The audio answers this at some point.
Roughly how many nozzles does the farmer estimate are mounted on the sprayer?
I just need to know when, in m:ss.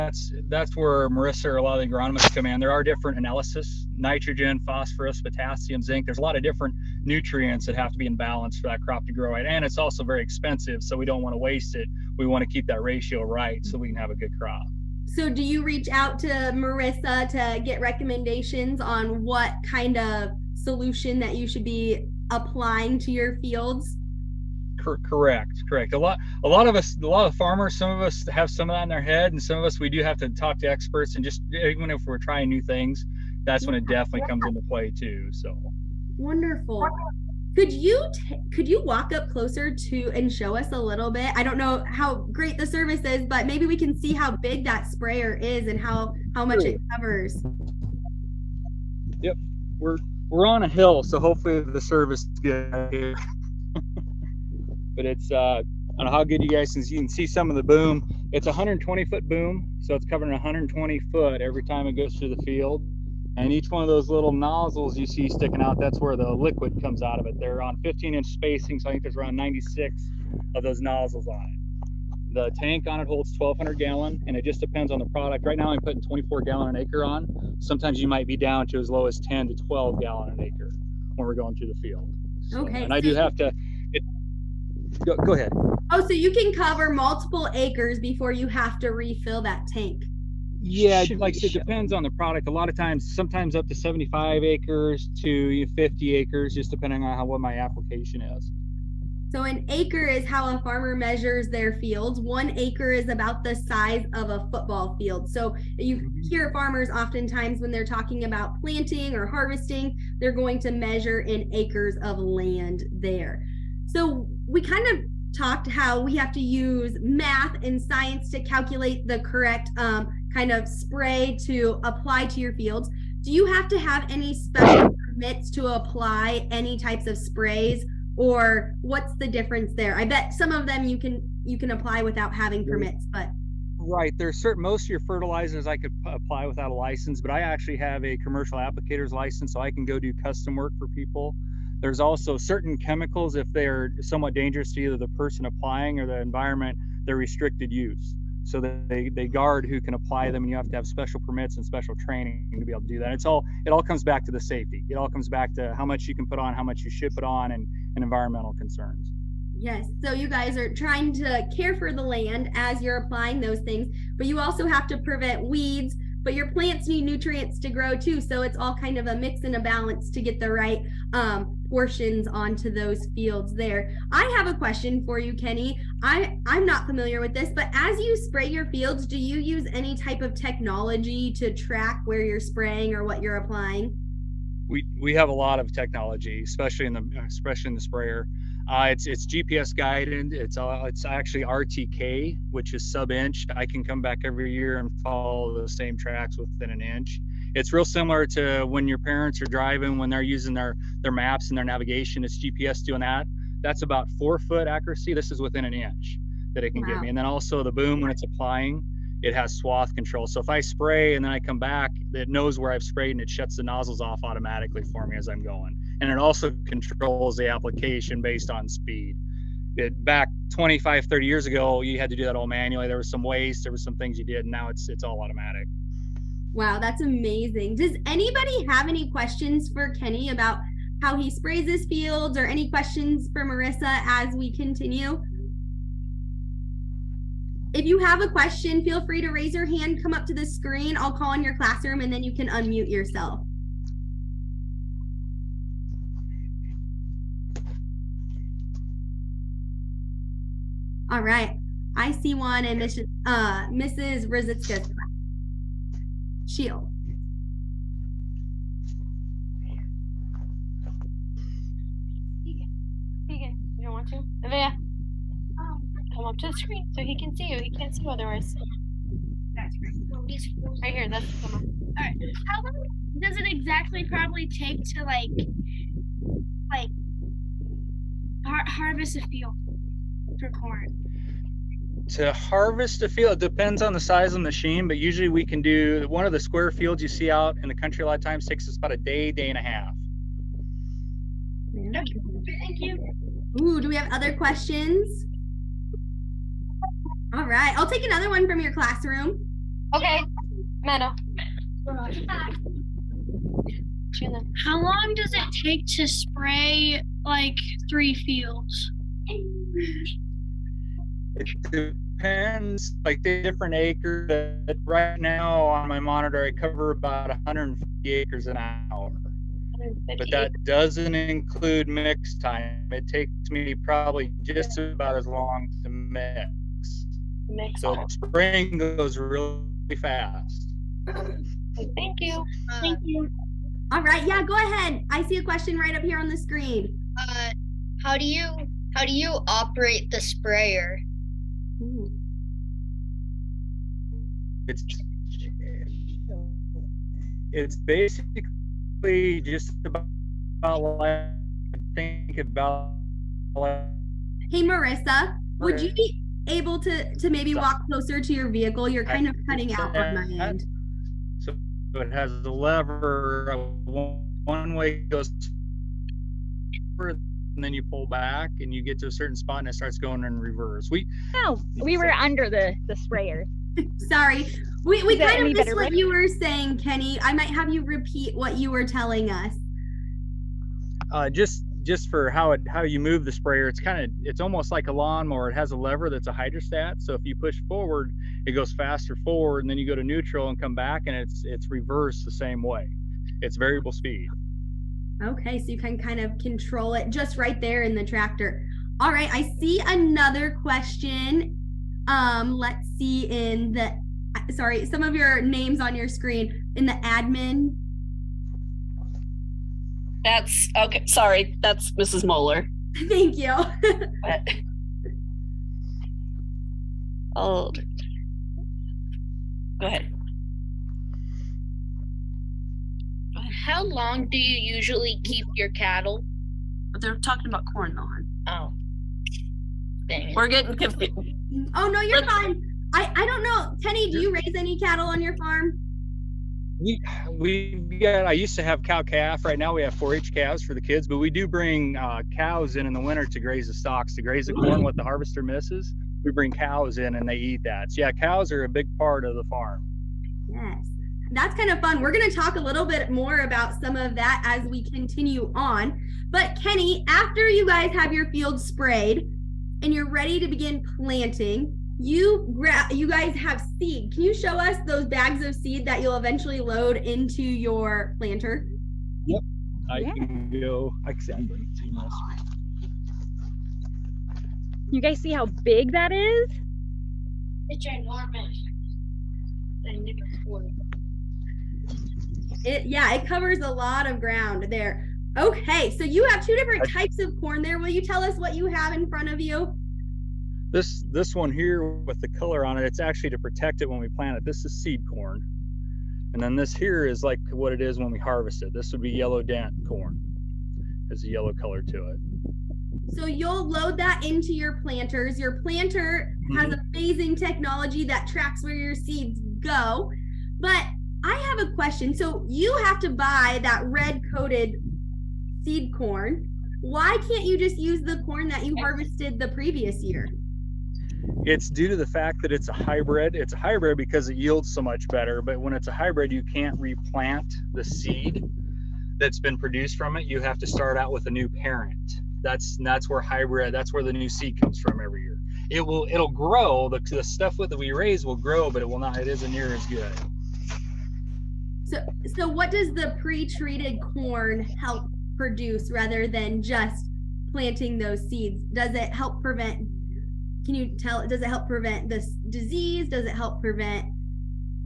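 1:09.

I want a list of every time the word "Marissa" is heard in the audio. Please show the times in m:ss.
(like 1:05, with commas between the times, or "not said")
0:01, 0:16, 3:53, 5:54.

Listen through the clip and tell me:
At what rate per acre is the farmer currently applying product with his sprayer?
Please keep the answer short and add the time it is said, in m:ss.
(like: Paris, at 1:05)
24 gallons per acre, at 1:16.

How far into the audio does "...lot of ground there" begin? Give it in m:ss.
8:03.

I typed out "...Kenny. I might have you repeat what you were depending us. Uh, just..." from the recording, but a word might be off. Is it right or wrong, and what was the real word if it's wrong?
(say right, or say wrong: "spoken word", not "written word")
wrong: "telling", not "depending".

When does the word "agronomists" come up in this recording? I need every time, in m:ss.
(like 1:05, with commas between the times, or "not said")
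0:01.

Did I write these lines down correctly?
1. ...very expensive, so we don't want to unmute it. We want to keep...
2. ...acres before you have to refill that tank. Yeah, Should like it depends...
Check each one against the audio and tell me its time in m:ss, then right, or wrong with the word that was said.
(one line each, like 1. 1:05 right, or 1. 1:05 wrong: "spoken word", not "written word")
1. 0:10 wrong: "waste", not "unmute"
2. 1:27 right.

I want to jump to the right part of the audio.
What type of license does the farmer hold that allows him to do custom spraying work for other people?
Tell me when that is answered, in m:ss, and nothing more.
2:18.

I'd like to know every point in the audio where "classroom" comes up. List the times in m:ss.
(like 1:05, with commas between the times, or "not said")
4:01, 4:58.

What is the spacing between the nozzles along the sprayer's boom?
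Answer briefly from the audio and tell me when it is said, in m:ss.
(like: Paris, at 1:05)
15 inches, at 1:07.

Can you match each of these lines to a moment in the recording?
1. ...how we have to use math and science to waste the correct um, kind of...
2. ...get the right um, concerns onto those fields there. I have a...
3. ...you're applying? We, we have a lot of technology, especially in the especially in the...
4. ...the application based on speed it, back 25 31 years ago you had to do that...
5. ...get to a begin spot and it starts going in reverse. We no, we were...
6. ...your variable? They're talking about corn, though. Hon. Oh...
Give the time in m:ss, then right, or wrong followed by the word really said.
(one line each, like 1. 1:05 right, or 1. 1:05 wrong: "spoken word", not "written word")
1. 1:55 wrong: "calculate", not "waste"
2. 2:50 wrong: "portions", not "concerns"
3. 3:03 right
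4. 3:37 wrong: "30", not "31"
5. 6:08 wrong: "certain", not "begin"
6. 7:05 wrong: "cattle", not "variable".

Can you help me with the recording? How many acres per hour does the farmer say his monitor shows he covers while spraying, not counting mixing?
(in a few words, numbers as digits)
150 acres.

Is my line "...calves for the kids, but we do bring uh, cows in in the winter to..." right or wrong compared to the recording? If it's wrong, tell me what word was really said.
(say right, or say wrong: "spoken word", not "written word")
right.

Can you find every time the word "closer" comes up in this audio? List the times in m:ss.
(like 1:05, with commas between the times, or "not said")
0:39, 5:57.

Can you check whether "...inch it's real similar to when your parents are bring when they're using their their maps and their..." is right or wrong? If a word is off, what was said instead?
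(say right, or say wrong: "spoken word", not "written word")
wrong: "driving", not "bring".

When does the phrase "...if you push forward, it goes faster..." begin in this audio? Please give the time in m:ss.
6:27.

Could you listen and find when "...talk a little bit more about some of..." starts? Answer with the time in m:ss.
7:32.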